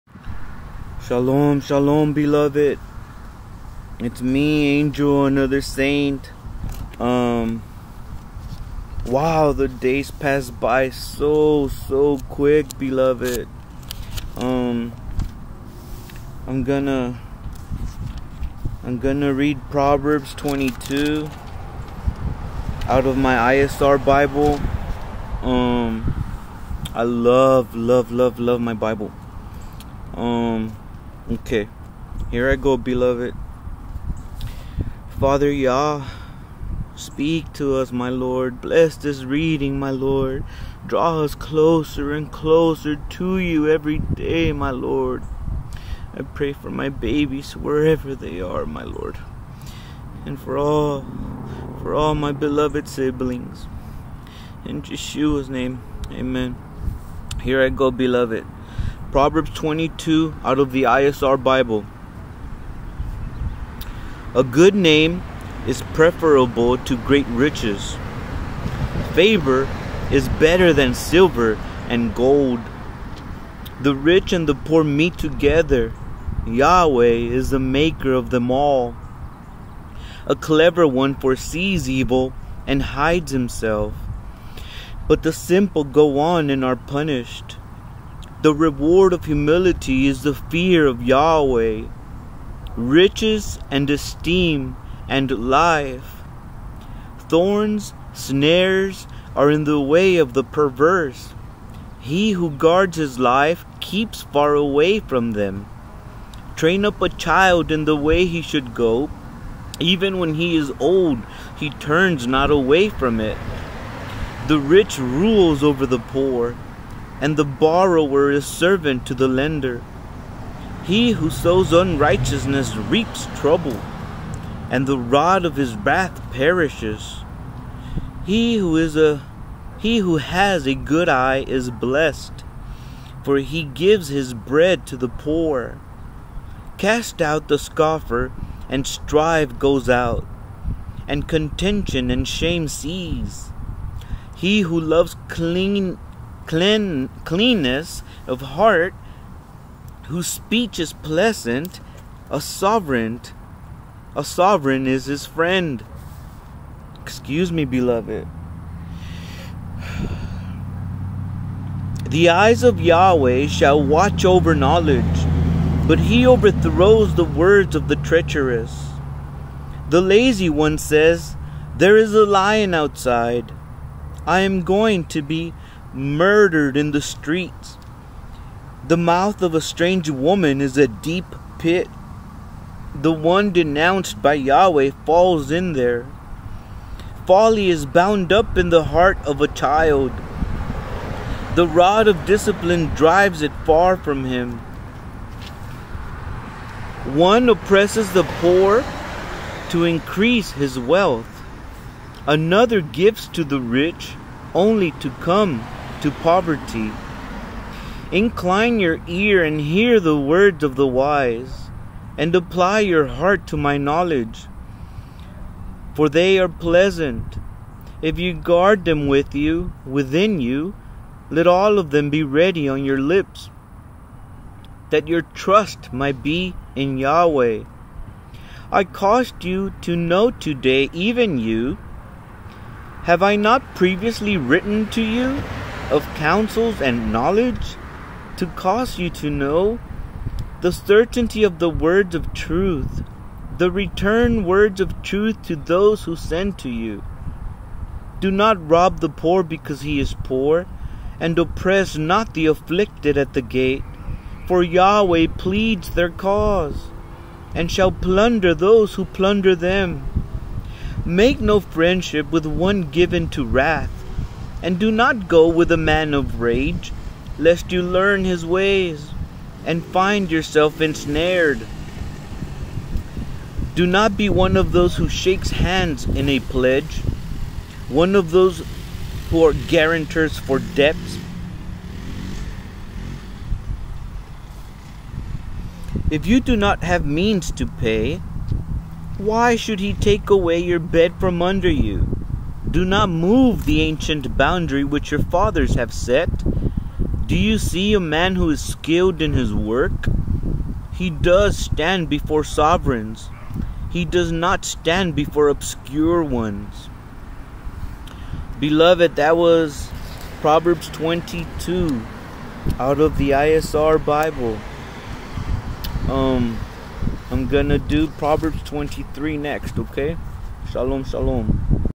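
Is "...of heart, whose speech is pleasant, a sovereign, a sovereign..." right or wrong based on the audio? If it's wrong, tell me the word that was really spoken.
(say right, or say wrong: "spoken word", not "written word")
right.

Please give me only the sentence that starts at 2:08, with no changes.
He who is a he who has a good eye is blessed, for he gives his bread to the poor.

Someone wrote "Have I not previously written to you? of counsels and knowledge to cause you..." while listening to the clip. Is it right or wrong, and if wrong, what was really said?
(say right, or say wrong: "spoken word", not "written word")
right.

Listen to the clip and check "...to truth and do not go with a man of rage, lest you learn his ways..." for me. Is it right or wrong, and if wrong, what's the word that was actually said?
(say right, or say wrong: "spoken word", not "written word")
wrong: "wrath", not "truth".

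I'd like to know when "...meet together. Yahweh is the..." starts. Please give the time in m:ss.
1:14.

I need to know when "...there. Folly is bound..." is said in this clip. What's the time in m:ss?
3:05.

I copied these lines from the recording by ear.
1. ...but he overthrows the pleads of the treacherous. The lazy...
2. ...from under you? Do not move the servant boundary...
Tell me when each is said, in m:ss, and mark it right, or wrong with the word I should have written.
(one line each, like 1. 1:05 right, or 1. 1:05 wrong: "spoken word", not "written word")
1. 2:45 wrong: "words", not "pleads"
2. 4:51 wrong: "ancient", not "servant".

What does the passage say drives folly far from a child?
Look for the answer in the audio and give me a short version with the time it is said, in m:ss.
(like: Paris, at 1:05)
The rod of discipline, at 3:11.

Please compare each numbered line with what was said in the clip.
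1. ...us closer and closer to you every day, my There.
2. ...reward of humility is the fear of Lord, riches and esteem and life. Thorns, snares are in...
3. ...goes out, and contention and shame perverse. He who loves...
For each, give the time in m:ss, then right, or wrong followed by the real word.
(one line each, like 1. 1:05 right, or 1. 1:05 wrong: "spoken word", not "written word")
1. 0:41 wrong: "Lord", not "There"
2. 1:28 wrong: "Yahweh", not "Lord"
3. 2:19 wrong: "cease", not "perverse".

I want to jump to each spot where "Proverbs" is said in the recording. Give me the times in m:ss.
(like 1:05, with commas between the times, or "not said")
0:19, 0:59, 5:10, 5:18.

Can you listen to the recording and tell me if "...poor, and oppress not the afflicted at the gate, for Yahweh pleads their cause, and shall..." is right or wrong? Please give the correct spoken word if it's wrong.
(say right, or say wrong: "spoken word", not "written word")
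right.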